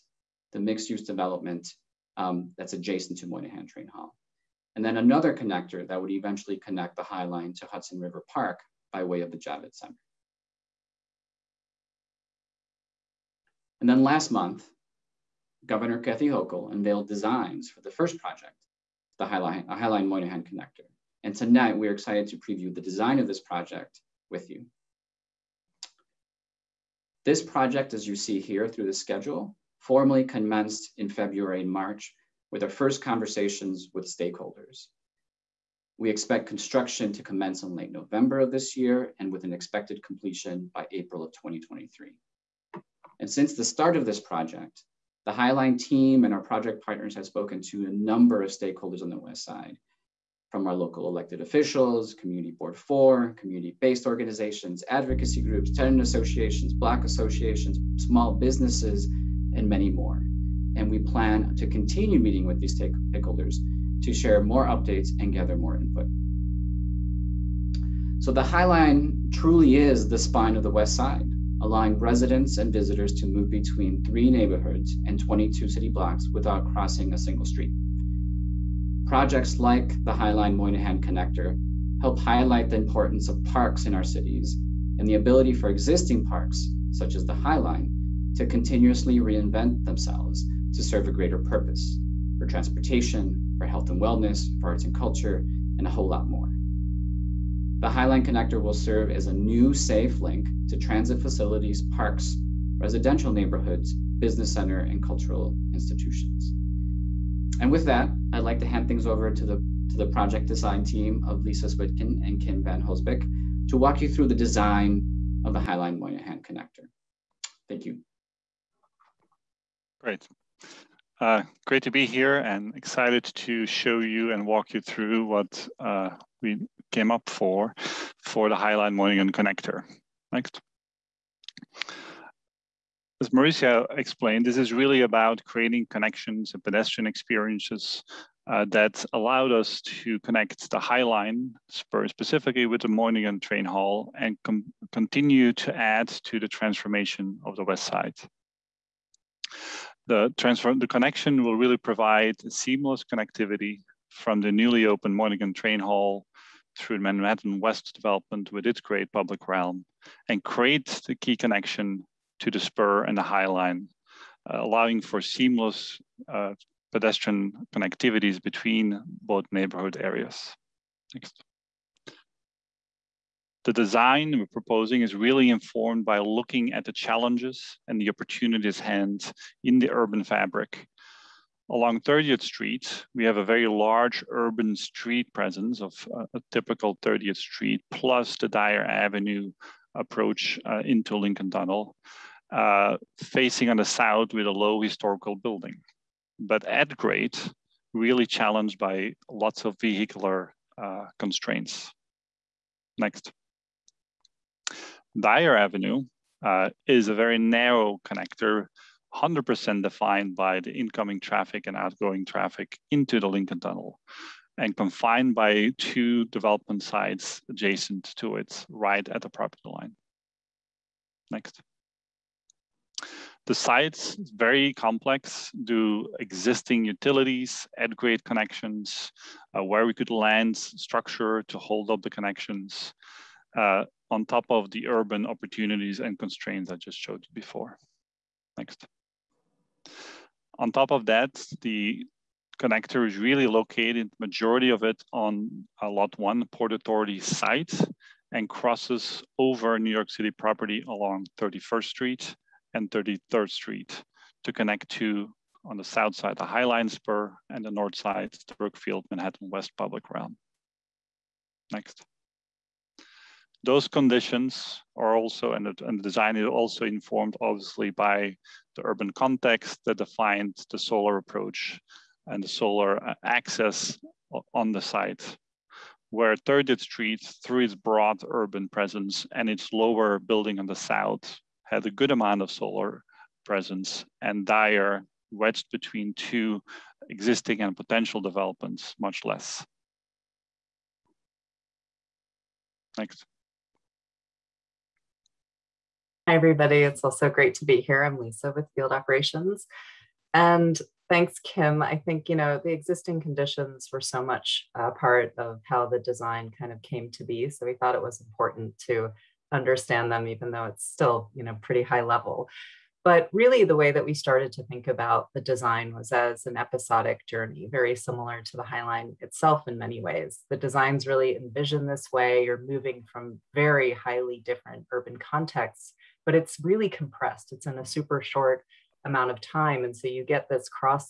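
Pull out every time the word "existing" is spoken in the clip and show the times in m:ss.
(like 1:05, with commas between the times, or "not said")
1:25, 3:46, 4:47, 5:02.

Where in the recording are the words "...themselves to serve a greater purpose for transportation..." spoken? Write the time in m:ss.
1:29.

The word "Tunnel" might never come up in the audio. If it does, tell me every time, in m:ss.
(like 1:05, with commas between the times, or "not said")
3:11, 3:33.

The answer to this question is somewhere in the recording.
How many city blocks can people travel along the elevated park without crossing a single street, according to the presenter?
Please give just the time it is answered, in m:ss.
1:15.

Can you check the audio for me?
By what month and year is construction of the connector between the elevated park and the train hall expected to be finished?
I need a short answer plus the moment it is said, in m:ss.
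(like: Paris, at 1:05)
April 2023, at 0:40.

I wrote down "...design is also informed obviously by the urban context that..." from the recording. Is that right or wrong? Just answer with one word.
right.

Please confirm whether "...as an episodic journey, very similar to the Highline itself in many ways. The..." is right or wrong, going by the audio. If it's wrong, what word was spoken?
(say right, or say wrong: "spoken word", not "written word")
right.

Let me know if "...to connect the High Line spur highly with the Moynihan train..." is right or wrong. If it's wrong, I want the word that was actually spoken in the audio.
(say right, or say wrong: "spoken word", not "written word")
wrong: "specifically", not "highly".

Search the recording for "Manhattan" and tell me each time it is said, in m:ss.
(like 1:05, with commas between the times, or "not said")
2:36, 4:19.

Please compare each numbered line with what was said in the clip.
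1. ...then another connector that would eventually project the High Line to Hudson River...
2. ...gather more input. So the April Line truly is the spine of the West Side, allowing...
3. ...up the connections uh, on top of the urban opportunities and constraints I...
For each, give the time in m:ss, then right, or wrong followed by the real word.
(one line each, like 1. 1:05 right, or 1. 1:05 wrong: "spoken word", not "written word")
1. 0:04 wrong: "connect", not "project"
2. 1:05 wrong: "High", not "April"
3. 3:51 right.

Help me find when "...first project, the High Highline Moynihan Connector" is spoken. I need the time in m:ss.
0:17.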